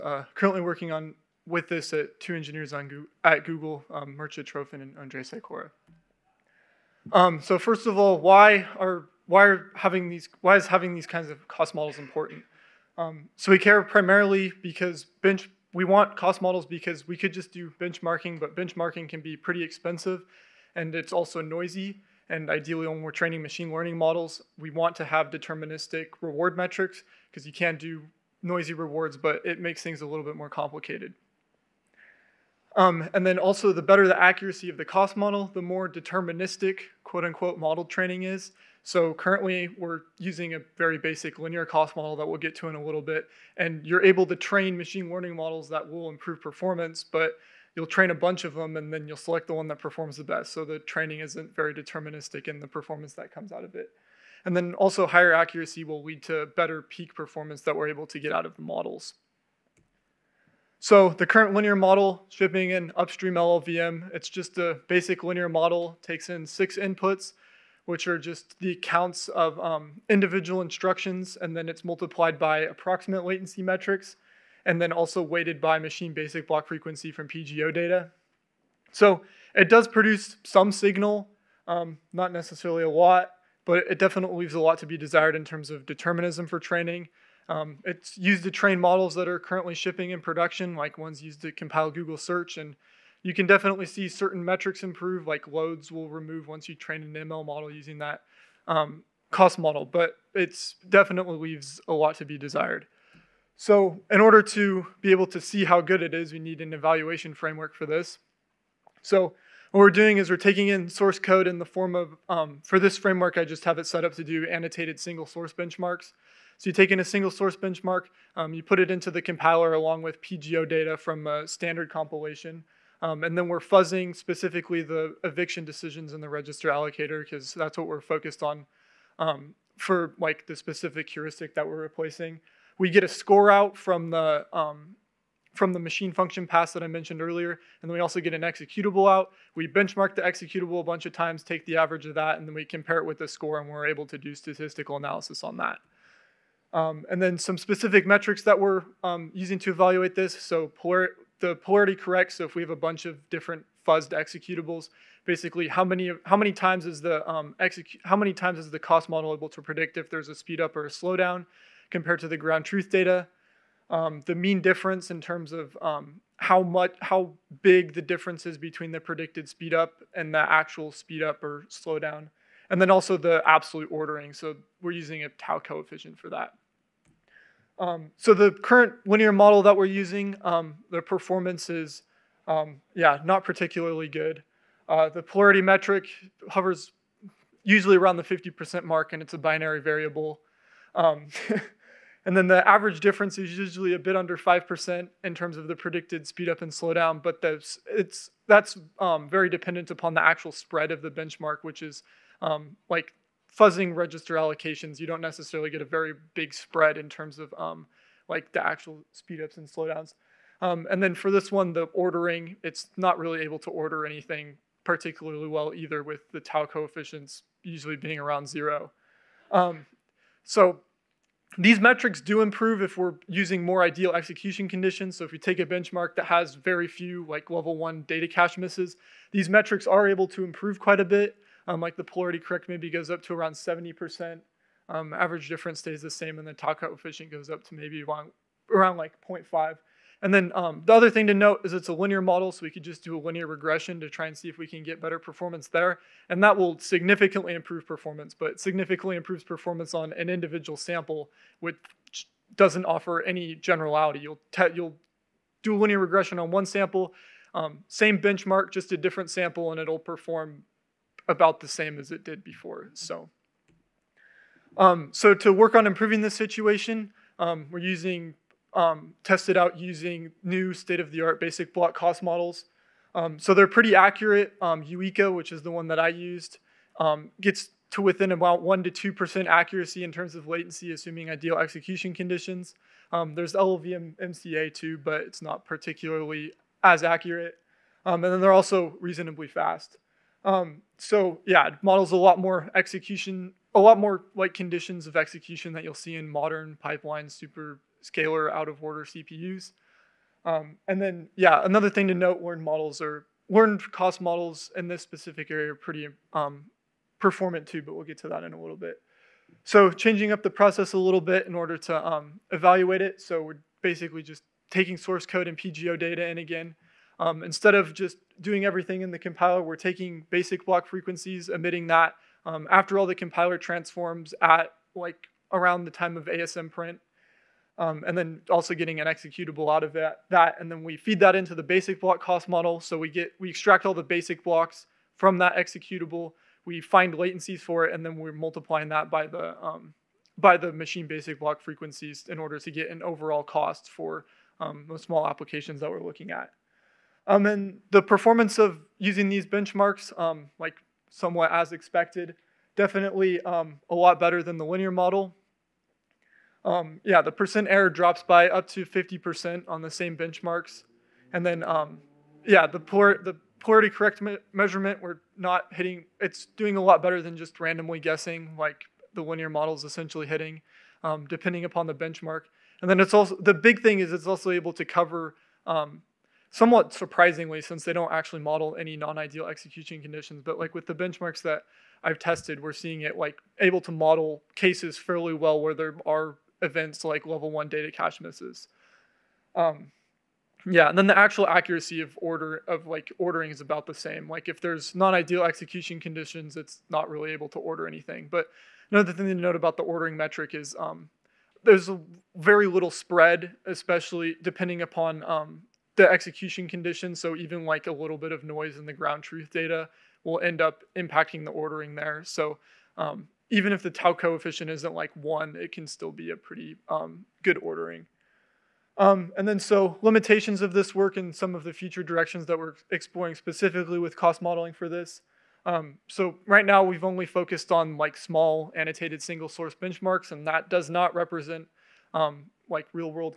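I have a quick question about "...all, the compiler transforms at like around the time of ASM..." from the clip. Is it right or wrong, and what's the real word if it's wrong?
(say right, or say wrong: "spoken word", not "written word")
right.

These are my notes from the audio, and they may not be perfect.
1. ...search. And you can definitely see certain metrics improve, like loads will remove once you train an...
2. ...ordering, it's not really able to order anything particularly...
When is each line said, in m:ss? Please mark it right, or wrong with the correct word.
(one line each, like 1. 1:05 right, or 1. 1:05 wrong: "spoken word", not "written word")
1. 1:32 right
2. 3:31 right.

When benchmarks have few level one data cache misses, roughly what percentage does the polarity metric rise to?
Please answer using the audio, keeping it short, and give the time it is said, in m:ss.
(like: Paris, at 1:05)
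70%, at 3:53.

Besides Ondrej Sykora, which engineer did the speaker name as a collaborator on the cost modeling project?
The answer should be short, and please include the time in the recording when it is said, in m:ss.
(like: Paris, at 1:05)
Mircea Trofin, at 0:04.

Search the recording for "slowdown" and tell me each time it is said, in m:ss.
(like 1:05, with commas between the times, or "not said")
2:40, 2:51, 3:16, 3:29.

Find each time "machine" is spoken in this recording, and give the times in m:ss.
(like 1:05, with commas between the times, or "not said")
0:23, 0:44, 1:15, 2:15, 5:40.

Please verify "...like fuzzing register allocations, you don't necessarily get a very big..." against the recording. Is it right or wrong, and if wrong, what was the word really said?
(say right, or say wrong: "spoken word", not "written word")
right.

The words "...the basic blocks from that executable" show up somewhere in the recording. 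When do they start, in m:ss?
5:33.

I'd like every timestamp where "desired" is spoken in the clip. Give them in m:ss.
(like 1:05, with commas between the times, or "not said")
1:24, 1:42.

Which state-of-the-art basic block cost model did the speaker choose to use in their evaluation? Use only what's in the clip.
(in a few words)
uiCA.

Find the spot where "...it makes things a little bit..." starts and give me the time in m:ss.
0:29.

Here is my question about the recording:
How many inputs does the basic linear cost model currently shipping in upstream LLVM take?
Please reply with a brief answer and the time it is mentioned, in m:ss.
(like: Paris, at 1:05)
6, at 1:06.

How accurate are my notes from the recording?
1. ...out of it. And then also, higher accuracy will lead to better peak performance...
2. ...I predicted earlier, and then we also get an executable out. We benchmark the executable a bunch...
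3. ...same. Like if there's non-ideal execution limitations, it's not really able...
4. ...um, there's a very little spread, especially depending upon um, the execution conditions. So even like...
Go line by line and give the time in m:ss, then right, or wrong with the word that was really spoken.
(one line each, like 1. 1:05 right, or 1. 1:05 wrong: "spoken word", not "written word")
1. 0:53 right
2. 2:16 wrong: "mentioned", not "predicted"
3. 6:33 wrong: "conditions", not "limitations"
4. 6:40 right.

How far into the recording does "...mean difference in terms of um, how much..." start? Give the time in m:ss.
2:44.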